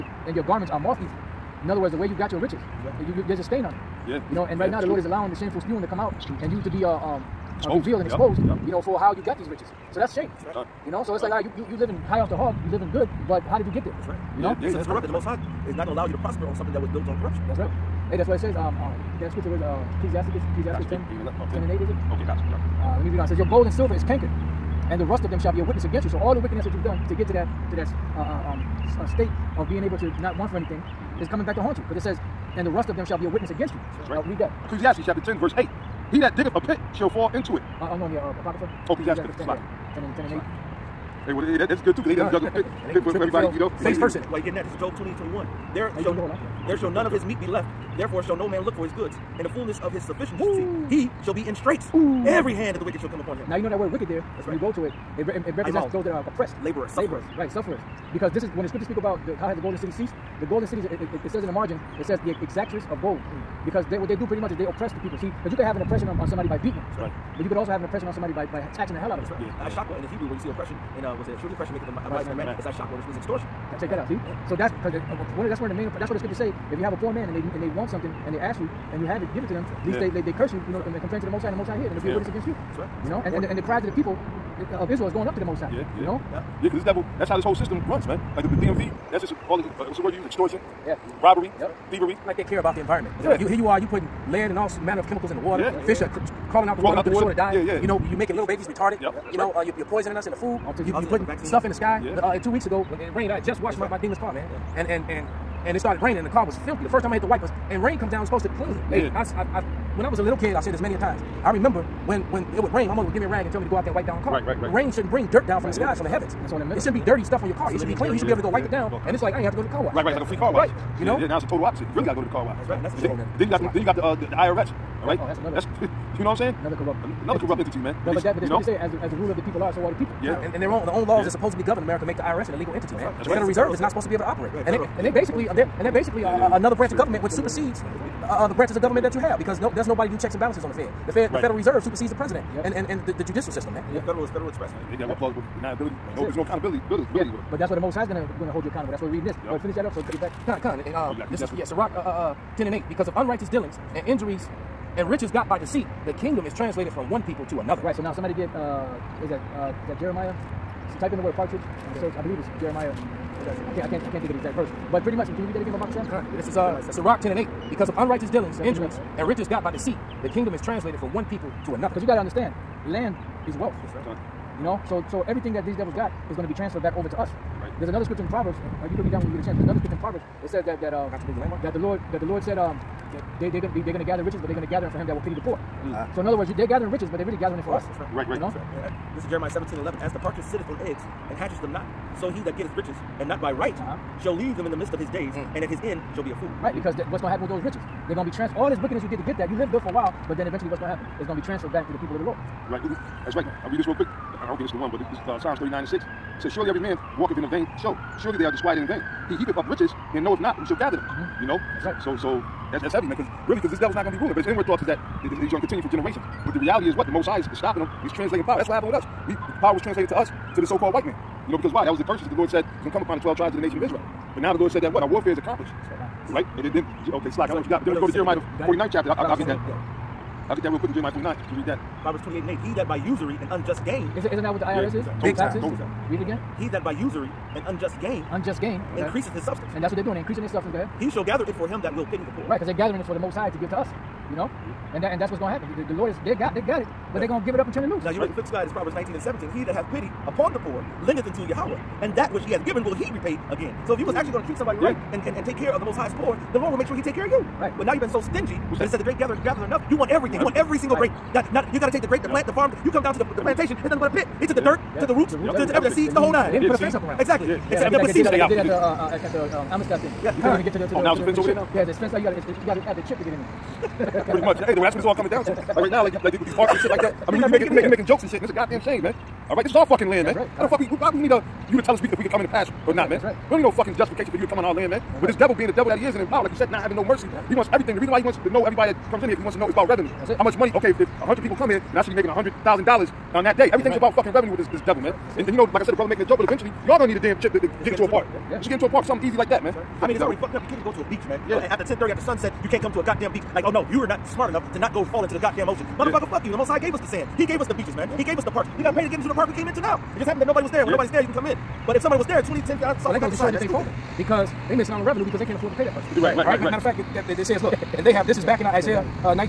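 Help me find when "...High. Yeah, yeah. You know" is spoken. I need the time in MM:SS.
01:25.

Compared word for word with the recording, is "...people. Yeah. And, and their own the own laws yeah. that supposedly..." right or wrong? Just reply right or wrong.
right.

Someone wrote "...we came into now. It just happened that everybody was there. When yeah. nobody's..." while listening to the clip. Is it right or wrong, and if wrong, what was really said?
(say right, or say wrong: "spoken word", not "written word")
wrong: "nobody", not "everybody".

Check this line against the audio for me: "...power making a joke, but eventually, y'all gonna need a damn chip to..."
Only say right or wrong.
wrong.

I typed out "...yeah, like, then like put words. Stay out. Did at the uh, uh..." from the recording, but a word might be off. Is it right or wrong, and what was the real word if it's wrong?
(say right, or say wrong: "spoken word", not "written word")
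wrong: "seeds", not "words".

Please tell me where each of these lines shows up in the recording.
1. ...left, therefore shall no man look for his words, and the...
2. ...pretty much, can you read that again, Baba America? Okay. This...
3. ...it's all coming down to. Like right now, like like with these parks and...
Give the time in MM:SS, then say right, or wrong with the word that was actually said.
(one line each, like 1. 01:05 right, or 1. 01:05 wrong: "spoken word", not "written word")
1. 00:47 wrong: "goods", not "words"
2. 02:45 wrong: "Sam", not "America"
3. 04:34 right.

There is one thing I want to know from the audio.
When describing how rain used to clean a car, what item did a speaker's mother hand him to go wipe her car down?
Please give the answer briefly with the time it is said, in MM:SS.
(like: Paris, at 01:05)
a rag, at 01:53.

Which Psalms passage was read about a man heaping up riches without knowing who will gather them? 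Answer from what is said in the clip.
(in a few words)
Psalms 39:6.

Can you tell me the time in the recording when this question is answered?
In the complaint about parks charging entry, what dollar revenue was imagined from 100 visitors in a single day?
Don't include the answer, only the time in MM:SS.
04:52.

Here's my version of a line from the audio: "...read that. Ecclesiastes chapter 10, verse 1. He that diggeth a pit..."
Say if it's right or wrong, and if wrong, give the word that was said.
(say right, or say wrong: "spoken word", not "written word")
wrong: "8", not "1".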